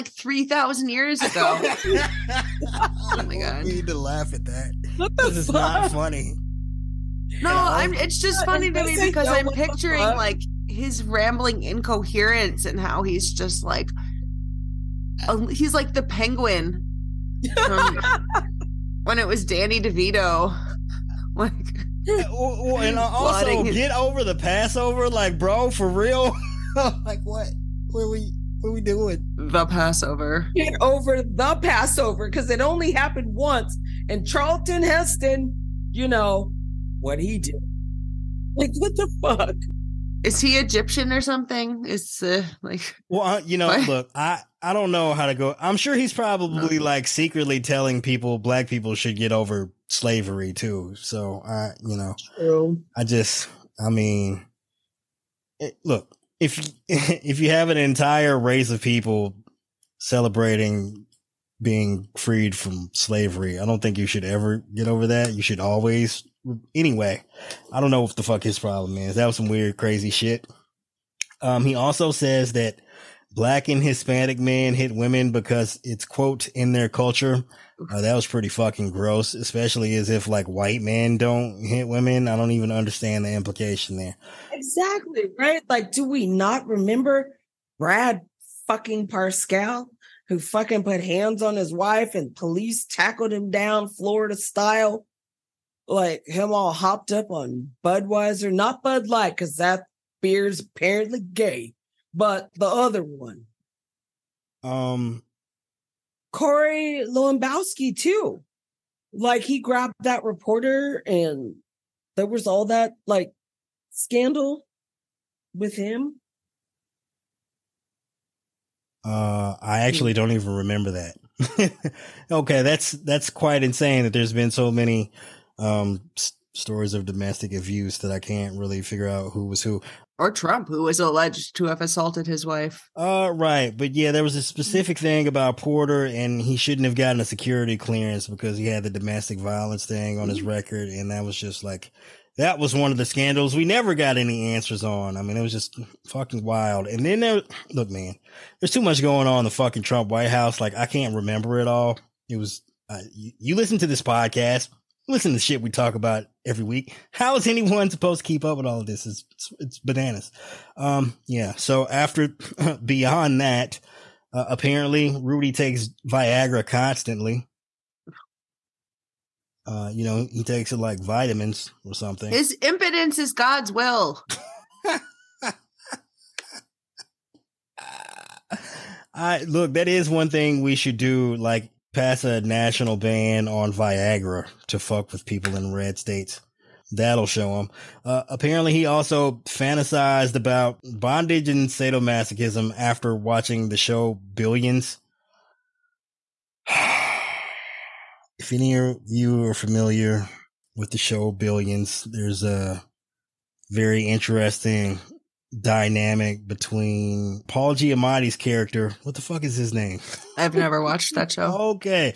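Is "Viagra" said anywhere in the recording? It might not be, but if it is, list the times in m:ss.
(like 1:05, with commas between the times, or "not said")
2:46, 3:03.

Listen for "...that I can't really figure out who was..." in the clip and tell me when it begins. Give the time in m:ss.
2:07.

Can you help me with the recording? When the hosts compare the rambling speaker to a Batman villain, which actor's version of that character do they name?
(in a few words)
Danny DeVito.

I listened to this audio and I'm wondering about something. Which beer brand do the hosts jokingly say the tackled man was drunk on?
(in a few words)
Budweiser.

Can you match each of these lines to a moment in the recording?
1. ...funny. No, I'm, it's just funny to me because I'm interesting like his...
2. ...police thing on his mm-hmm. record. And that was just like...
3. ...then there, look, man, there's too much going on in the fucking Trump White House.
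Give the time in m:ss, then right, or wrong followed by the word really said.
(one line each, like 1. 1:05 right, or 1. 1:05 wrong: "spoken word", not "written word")
1. 0:05 wrong: "picturing", not "interesting"
2. 2:19 wrong: "violence", not "police"
3. 2:27 right.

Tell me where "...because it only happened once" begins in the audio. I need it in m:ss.
0:32.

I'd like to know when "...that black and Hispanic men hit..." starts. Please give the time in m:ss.
1:12.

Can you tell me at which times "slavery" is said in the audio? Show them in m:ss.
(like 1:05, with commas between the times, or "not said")
0:49, 1:02.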